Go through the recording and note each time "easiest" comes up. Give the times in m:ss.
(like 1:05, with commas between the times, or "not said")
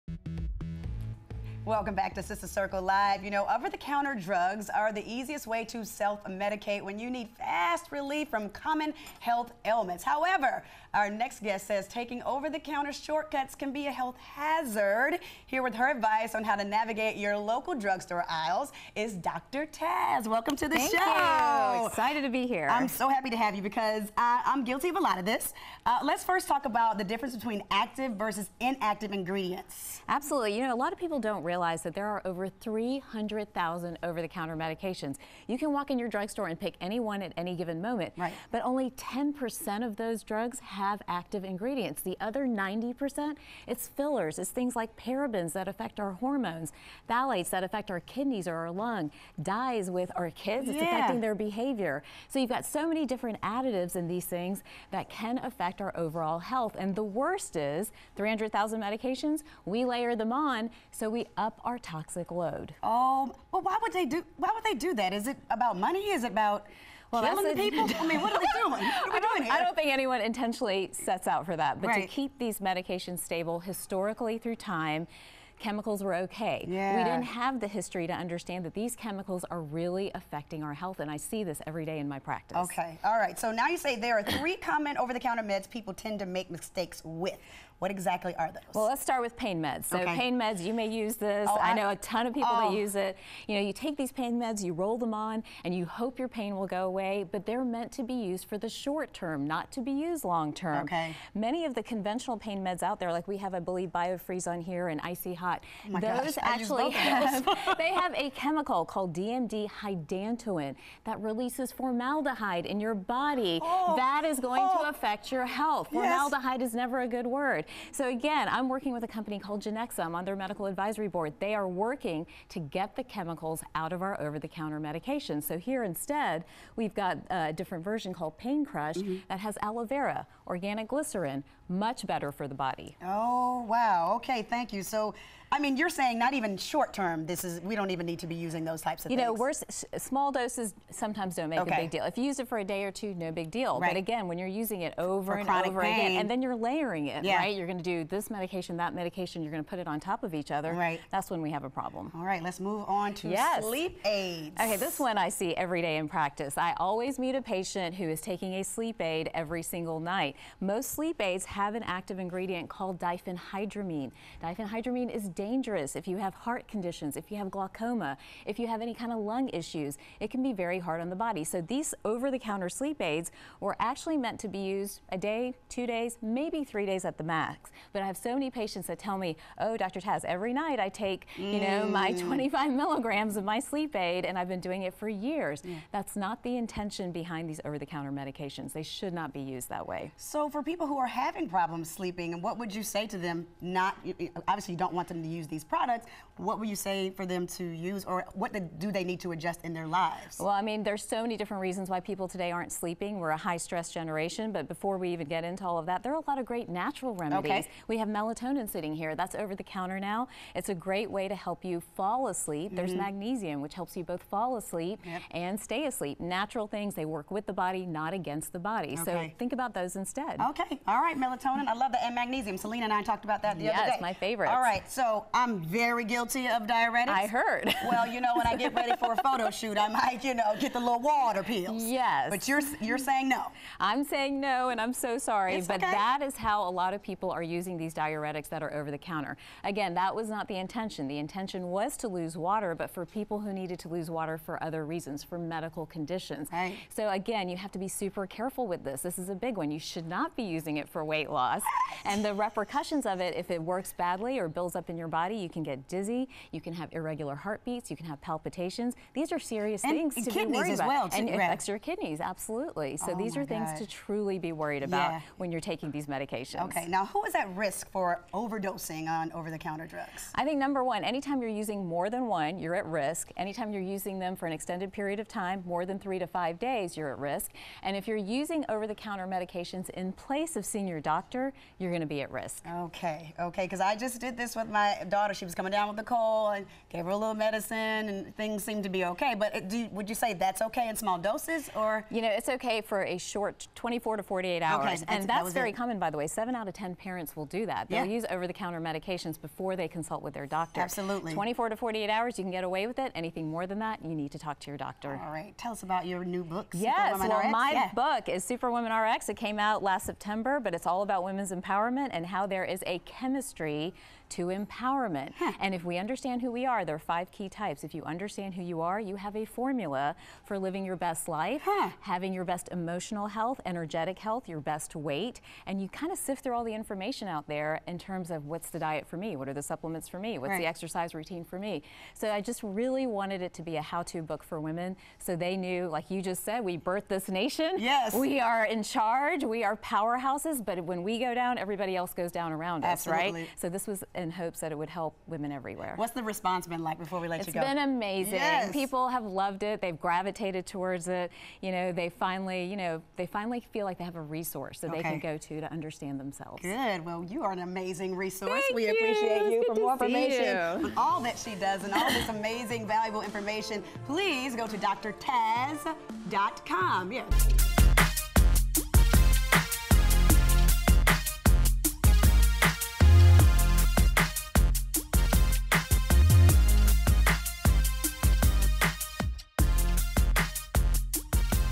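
0:05.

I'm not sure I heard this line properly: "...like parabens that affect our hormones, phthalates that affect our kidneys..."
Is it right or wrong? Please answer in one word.
right.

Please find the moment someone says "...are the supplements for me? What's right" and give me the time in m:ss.
5:29.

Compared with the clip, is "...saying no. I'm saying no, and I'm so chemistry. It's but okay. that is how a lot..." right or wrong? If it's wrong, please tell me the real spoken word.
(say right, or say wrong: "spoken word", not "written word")
wrong: "sorry", not "chemistry".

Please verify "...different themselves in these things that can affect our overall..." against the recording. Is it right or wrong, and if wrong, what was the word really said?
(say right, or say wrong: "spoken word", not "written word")
wrong: "additives", not "themselves".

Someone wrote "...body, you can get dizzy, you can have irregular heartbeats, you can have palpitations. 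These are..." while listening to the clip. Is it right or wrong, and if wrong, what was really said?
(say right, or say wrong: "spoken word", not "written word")
right.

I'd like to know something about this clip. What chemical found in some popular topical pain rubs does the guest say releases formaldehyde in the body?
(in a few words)
DMDM hydantoin.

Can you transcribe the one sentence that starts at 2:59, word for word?
Taz, every night I take, mm.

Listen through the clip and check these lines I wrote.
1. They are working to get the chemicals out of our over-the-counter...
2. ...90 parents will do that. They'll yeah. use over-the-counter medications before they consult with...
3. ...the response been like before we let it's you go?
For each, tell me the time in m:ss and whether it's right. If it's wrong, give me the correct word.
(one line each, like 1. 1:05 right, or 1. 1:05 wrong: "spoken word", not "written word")
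1. 2:01 right
2. 4:56 wrong: "10", not "90"
3. 5:46 right.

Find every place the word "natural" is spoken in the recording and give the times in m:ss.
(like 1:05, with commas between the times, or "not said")
3:26, 3:36.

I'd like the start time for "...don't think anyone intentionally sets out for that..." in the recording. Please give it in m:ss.
1:09.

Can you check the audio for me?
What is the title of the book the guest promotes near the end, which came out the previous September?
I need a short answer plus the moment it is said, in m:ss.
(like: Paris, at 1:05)
Superwoman RX, at 5:08.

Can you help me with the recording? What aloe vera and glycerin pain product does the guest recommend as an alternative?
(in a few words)
Pain Crush.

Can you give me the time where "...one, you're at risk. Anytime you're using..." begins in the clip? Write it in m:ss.
4:32.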